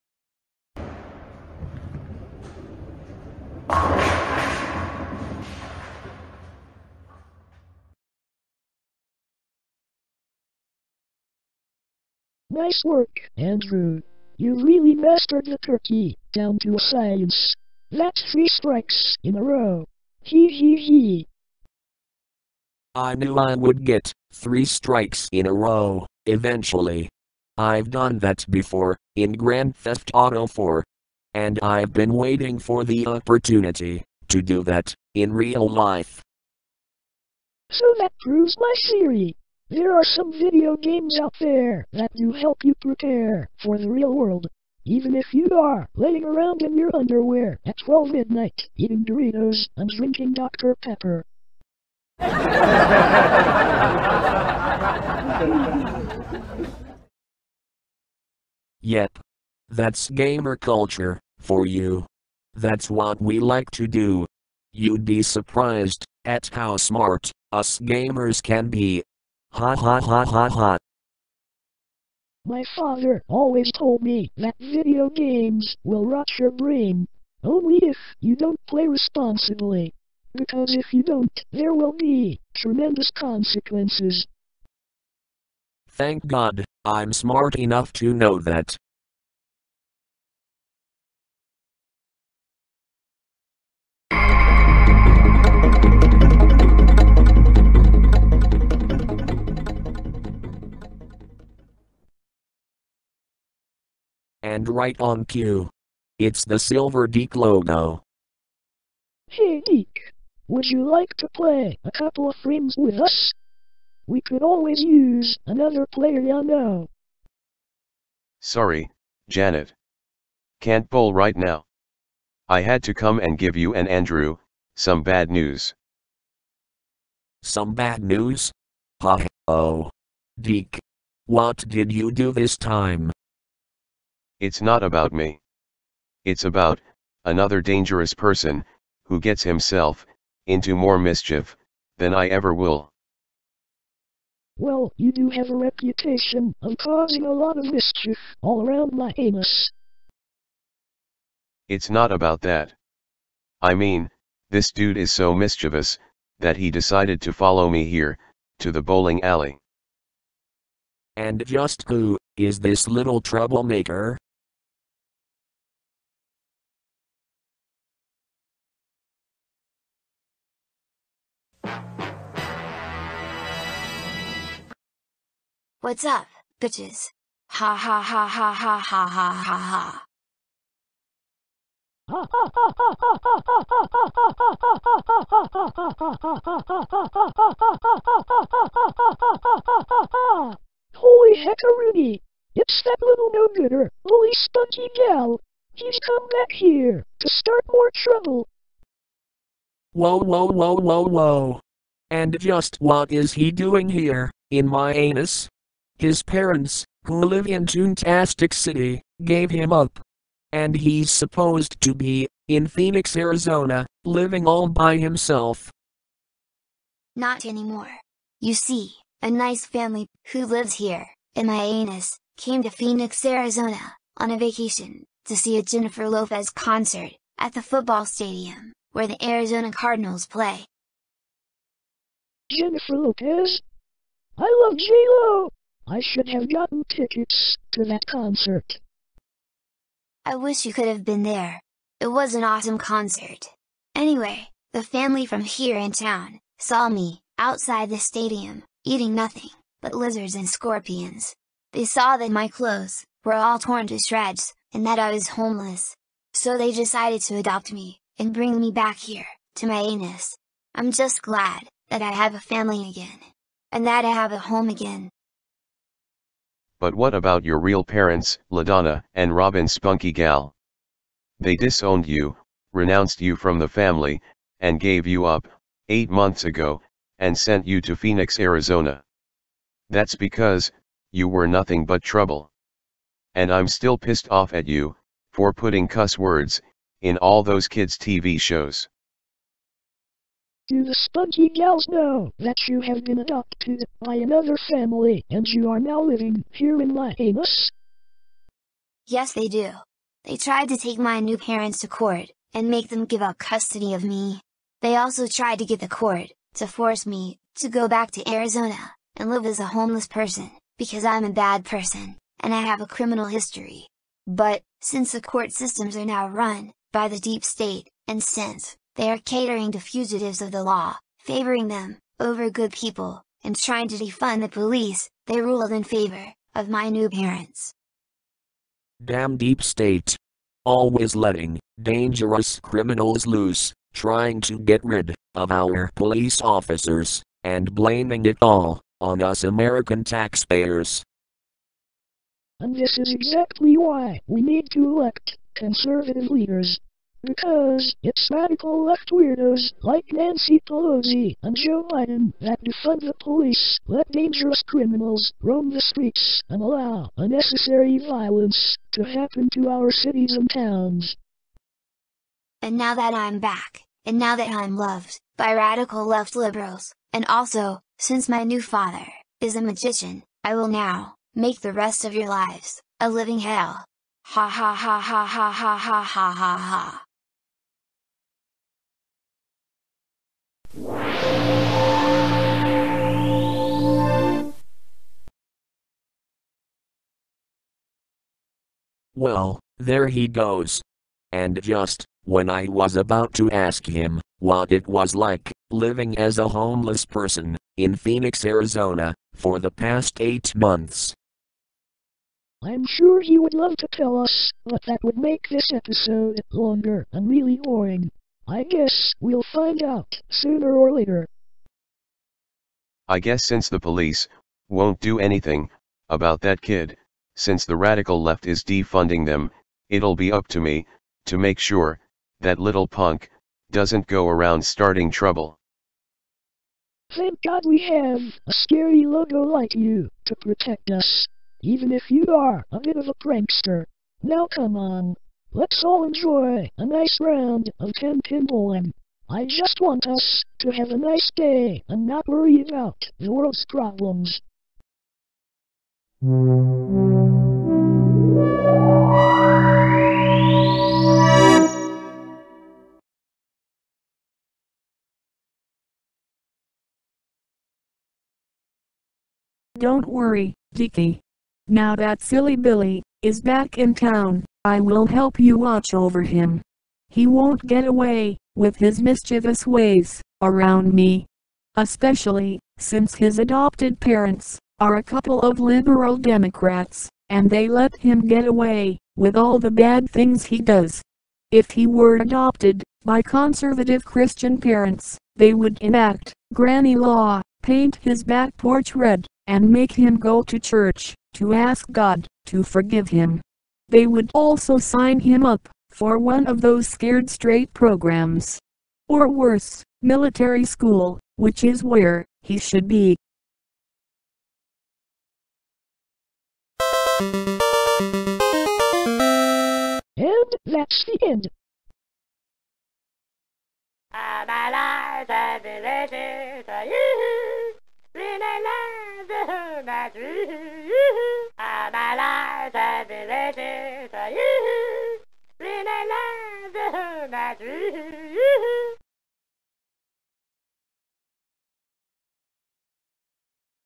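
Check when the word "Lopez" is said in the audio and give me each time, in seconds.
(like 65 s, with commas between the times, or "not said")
226 s, 232 s.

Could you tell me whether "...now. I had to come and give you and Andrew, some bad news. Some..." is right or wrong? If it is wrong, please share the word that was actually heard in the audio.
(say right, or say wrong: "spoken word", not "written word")
right.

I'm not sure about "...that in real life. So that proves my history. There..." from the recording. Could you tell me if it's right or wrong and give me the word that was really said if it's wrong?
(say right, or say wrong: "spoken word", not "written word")
wrong: "theory", not "history".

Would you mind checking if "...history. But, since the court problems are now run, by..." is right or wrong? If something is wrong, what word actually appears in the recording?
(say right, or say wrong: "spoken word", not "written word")
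wrong: "systems", not "problems".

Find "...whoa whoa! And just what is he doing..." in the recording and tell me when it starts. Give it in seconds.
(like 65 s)
200 s.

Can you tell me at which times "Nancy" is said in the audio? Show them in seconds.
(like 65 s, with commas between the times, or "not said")
350 s.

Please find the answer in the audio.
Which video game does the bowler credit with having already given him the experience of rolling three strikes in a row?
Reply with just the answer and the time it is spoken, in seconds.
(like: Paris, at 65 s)
Grand Theft Auto 4, at 29 s.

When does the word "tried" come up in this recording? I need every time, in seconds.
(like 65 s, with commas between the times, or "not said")
300 s, 305 s.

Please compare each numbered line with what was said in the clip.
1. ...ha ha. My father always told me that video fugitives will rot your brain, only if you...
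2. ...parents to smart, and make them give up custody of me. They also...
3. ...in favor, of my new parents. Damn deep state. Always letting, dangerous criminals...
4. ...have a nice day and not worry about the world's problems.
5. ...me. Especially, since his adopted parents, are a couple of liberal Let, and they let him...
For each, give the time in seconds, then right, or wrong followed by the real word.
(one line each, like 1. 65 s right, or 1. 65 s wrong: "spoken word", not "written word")
1. 70 s wrong: "games", not "fugitives"
2. 301 s wrong: "court", not "smart"
3. 325 s right
4. 440 s right
5. 470 s wrong: "Democrats", not "Let".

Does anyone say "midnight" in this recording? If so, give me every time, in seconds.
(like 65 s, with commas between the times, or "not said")
48 s.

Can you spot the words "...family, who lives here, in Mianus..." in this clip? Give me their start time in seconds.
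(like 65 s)
219 s.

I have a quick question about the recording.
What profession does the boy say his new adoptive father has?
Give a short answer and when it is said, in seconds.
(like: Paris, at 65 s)
magician, at 369 s.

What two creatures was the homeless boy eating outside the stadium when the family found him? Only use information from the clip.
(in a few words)
lizards and scorpions.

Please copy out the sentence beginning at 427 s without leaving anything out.
Thank God we have a scary logo like you to protect us, even if you are a bit of a prankster.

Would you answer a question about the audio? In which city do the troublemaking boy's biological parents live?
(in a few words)
Toontastic City.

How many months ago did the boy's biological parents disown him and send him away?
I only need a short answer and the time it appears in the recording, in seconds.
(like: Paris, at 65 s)
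8, at 275 s.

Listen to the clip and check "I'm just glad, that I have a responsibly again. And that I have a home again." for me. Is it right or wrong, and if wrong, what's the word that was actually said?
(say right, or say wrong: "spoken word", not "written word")
wrong: "family", not "responsibly".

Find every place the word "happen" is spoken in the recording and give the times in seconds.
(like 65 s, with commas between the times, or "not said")
359 s.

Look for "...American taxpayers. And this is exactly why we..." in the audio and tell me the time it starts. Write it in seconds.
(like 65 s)
339 s.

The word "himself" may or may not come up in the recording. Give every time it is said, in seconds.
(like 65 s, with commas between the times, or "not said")
139 s, 214 s.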